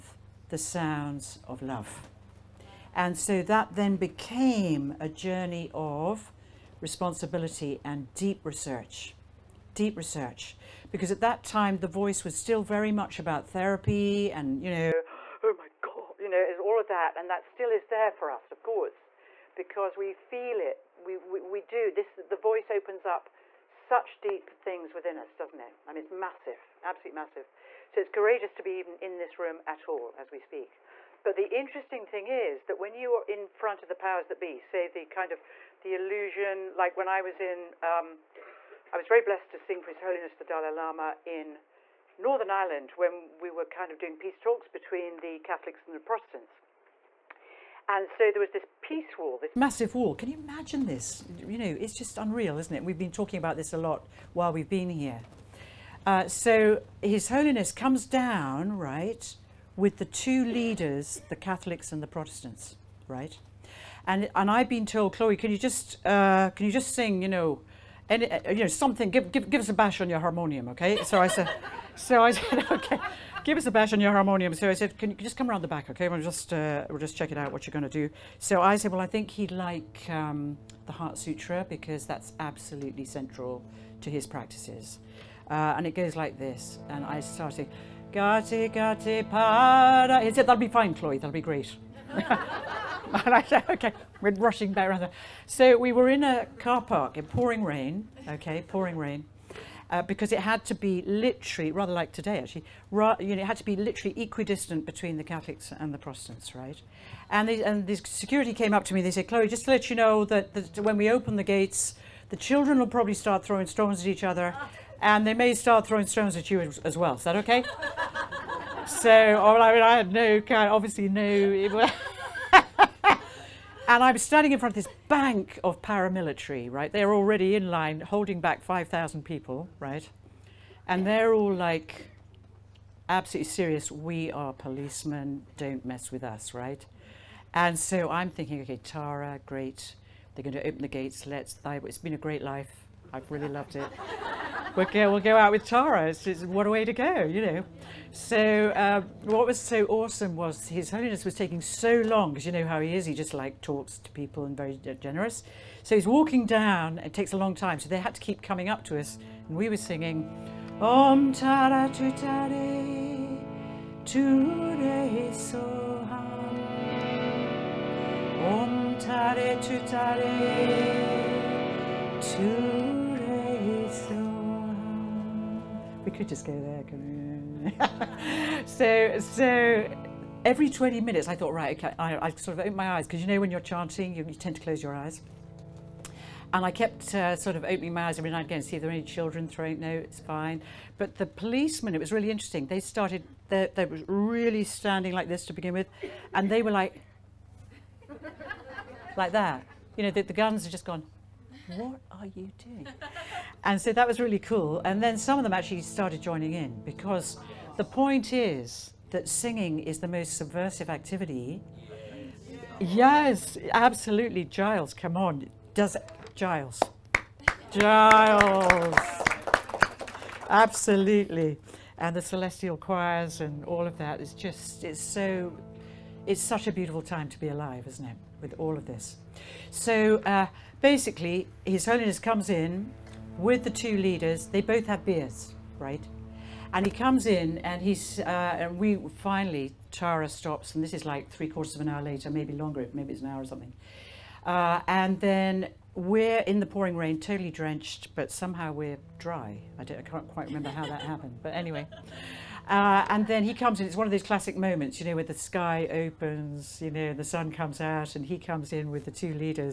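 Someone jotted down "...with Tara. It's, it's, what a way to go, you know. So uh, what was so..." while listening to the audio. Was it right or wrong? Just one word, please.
right.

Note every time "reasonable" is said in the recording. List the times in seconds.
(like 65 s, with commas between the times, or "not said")
not said.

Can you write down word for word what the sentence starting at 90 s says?
He said, that'll be fine, Chloe, that'll be great.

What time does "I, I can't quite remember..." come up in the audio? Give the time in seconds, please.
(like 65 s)
249 s.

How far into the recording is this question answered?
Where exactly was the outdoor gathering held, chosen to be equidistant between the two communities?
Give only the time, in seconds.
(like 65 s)
96 s.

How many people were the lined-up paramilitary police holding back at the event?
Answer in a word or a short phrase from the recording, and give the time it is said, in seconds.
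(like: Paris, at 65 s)
5,000, at 128 s.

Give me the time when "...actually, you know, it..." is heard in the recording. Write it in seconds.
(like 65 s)
102 s.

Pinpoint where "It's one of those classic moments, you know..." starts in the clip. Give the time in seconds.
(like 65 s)
253 s.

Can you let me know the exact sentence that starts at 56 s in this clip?
Uh, so His Holiness comes down, right, with the two leaders, the Catholics and the Protestants, right?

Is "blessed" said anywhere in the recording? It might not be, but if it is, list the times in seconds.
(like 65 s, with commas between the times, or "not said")
39 s.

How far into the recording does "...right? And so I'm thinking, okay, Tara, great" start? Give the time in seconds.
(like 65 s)
136 s.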